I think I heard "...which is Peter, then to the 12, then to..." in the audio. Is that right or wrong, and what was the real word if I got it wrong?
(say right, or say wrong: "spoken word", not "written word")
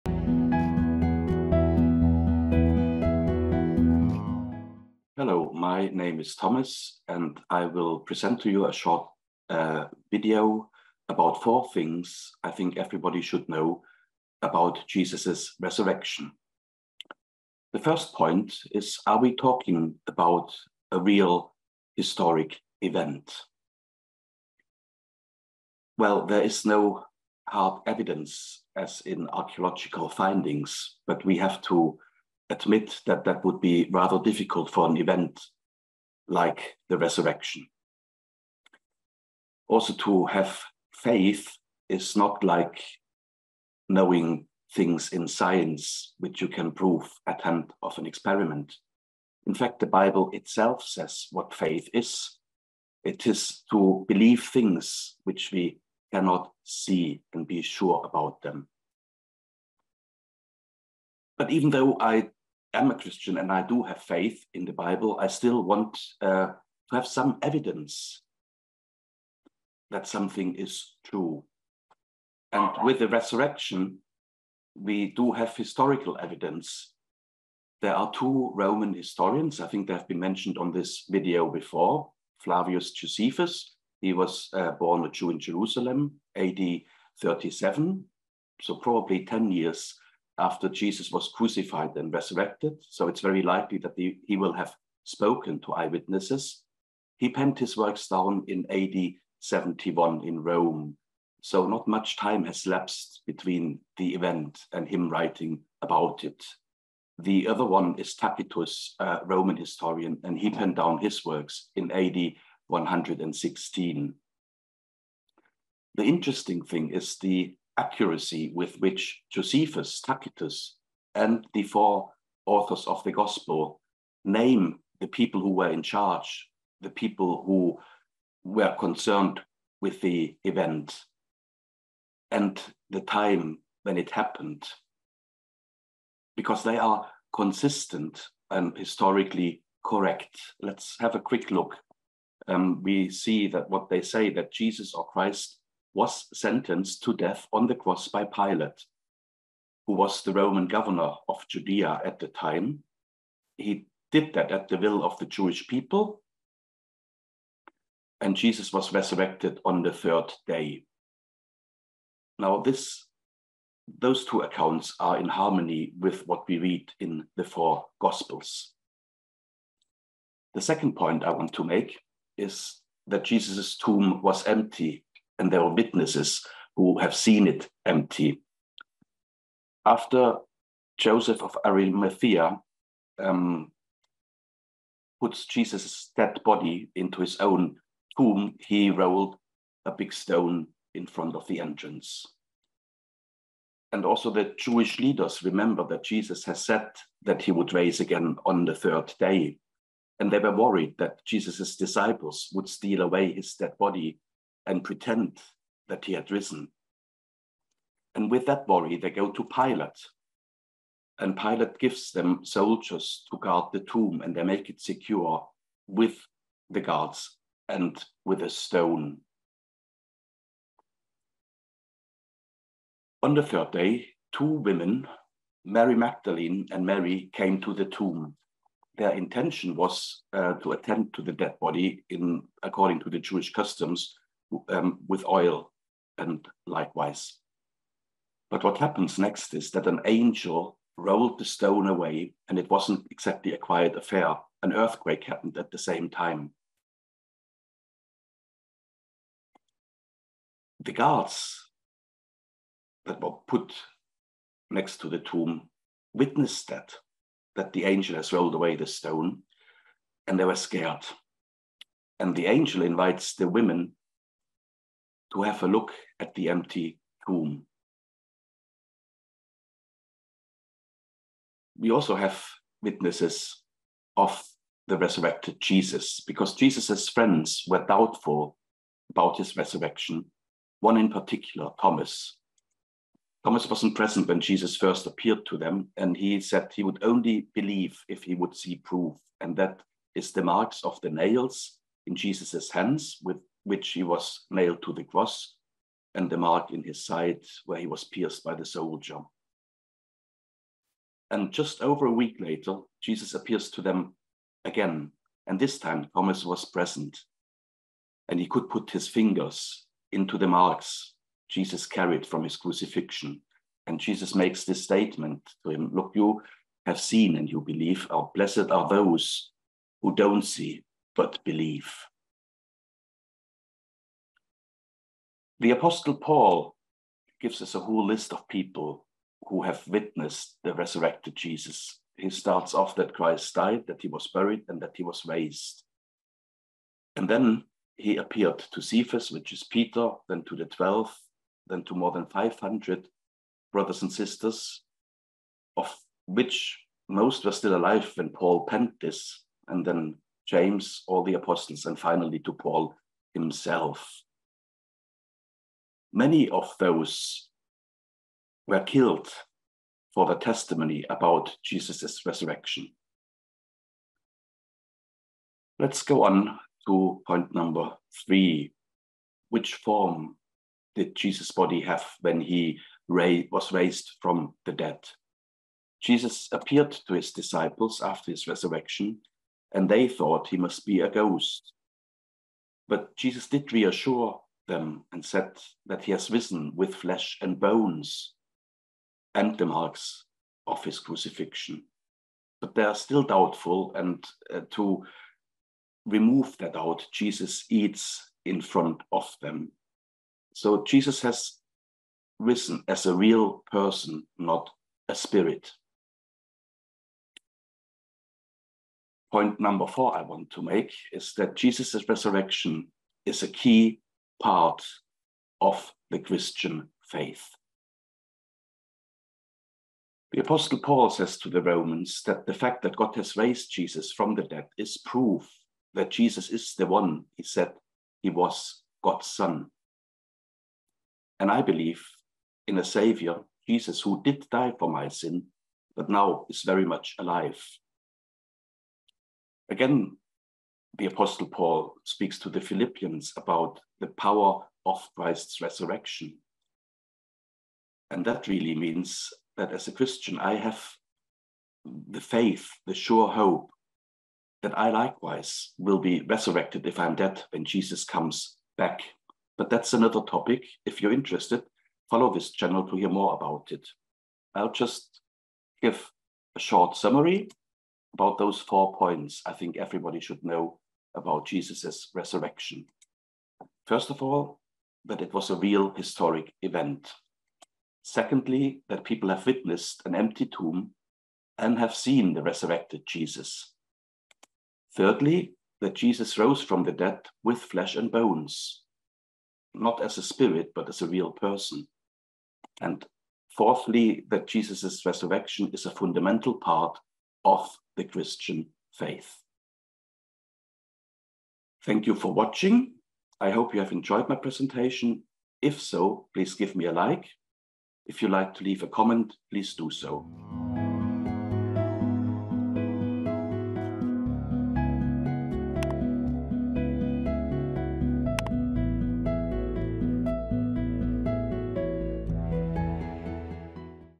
right.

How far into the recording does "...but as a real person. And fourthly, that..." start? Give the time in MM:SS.
08:10.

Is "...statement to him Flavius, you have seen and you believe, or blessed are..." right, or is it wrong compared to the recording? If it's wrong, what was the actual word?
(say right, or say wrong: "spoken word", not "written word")
wrong: "Look", not "Flavius".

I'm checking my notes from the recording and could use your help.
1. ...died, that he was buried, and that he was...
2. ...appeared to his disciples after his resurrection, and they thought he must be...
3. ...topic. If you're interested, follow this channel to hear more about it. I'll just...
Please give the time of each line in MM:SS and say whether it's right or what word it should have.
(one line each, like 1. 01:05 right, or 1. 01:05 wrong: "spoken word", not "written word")
1. 05:33 right
2. 06:16 right
3. 07:40 right.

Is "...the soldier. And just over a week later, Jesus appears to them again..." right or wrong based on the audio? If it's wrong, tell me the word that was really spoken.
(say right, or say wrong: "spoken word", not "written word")
right.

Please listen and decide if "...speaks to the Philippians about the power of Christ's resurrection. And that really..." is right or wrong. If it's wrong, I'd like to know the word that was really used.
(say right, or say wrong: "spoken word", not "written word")
right.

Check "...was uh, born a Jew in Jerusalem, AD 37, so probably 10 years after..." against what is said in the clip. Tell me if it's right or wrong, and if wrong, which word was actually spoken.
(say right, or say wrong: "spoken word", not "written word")
right.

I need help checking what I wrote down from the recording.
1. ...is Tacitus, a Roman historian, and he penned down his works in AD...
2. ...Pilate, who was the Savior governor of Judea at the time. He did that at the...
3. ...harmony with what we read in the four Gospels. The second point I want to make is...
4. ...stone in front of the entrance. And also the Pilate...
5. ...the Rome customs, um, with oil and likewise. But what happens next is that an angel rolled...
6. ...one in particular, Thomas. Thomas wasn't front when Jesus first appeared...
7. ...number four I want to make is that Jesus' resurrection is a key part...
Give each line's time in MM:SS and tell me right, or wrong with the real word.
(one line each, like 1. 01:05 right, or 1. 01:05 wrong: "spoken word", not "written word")
1. 01:47 right
2. 02:28 wrong: "Roman", not "Savior"
3. 02:45 right
4. 03:10 wrong: "Jewish", not "Pilate"
5. 03:53 wrong: "Jewish", not "Rome"
6. 04:40 wrong: "present", not "front"
7. 06:49 right.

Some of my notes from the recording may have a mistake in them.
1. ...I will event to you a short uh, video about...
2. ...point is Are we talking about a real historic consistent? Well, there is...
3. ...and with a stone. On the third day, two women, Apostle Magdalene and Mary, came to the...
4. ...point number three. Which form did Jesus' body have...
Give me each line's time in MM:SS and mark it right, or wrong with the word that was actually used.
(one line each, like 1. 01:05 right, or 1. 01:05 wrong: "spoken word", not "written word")
1. 00:07 wrong: "present", not "event"
2. 00:18 wrong: "event", not "consistent"
3. 03:37 wrong: "Mary", not "Apostle"
4. 06:07 right.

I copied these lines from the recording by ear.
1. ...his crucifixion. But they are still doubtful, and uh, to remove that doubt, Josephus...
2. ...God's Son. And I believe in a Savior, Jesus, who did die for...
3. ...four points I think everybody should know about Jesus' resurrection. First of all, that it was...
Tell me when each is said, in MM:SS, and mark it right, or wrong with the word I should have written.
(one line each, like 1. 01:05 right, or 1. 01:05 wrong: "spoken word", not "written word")
1. 06:30 wrong: "Jesus", not "Josephus"
2. 07:09 right
3. 07:48 right.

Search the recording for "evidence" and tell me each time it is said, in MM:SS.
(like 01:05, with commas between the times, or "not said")
00:27, 01:07, 01:16.